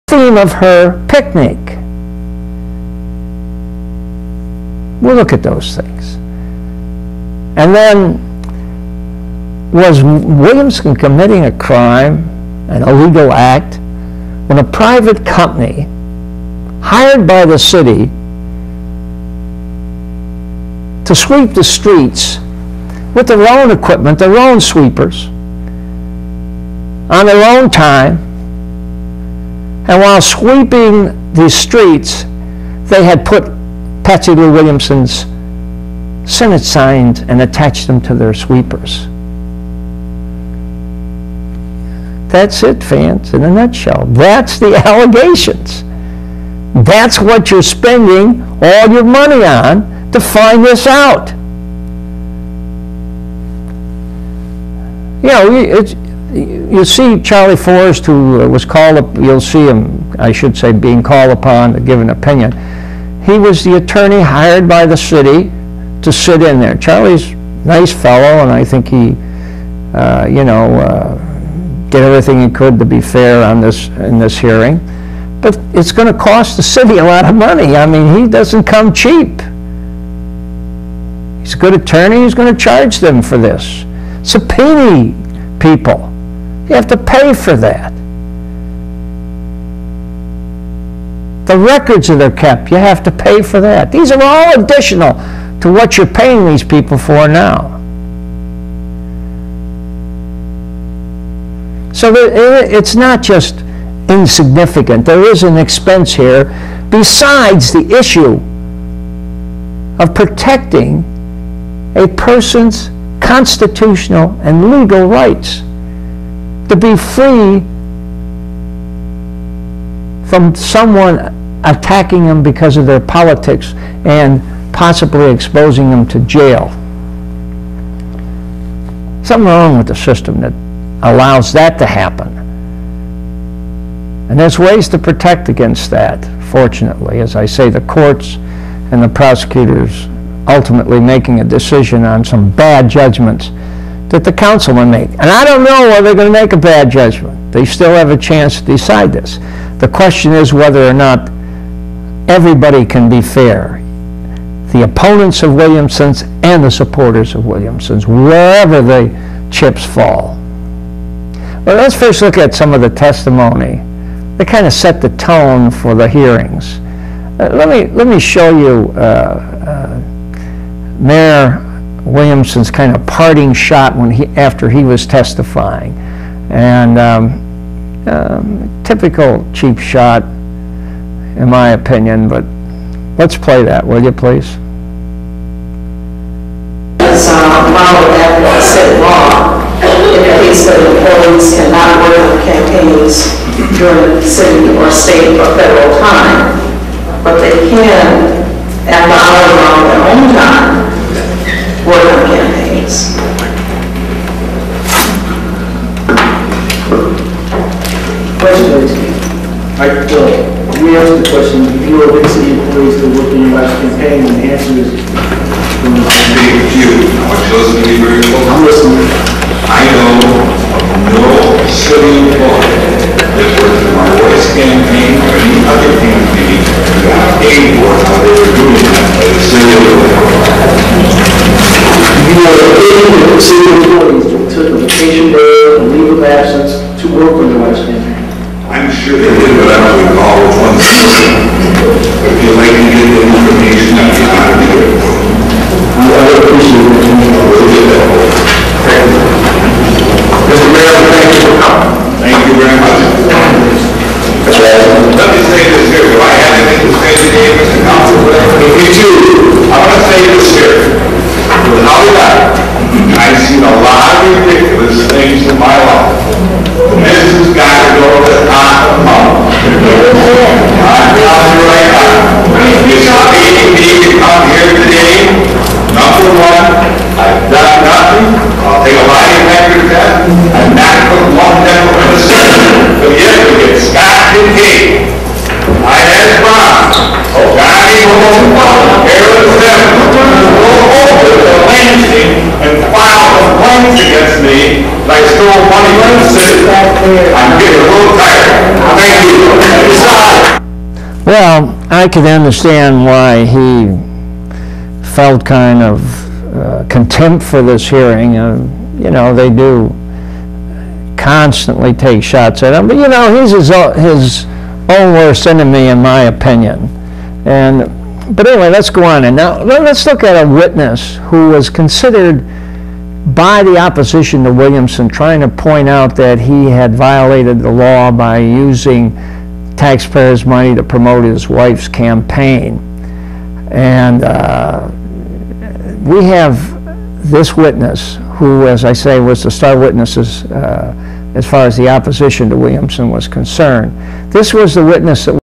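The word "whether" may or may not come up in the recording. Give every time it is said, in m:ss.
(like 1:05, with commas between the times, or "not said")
2:25, 2:30.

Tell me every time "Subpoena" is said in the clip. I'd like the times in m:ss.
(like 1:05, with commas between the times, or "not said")
1:24.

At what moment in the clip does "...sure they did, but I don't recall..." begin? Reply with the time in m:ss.
3:58.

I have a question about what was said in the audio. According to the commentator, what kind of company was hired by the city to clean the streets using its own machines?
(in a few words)
a private company.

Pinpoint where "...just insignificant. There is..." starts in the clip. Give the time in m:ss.
1:43.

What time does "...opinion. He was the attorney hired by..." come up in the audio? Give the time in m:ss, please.
1:02.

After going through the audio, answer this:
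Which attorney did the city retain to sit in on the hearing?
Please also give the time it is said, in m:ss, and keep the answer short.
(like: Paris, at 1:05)
Charlie Forrest, at 0:57.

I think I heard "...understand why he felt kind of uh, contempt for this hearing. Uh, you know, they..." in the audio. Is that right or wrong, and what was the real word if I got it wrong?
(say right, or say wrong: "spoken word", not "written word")
right.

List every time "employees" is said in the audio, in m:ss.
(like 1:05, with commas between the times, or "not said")
3:10, 3:32, 3:42, 3:53.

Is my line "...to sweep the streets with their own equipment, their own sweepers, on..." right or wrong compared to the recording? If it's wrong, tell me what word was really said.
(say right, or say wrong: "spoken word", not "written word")
right.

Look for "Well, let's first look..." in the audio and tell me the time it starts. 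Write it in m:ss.
2:41.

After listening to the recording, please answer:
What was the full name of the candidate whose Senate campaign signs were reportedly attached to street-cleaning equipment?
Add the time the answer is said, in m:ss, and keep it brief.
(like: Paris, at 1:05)
Patsy Lou Williamson, at 0:34.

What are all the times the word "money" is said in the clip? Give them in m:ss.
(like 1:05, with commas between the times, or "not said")
0:49, 1:17, 4:55, 5:30.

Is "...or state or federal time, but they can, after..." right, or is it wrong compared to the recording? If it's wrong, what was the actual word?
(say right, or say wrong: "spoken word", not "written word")
right.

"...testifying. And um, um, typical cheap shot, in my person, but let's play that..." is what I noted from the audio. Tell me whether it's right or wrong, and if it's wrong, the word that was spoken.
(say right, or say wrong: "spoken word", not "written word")
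wrong: "opinion", not "person".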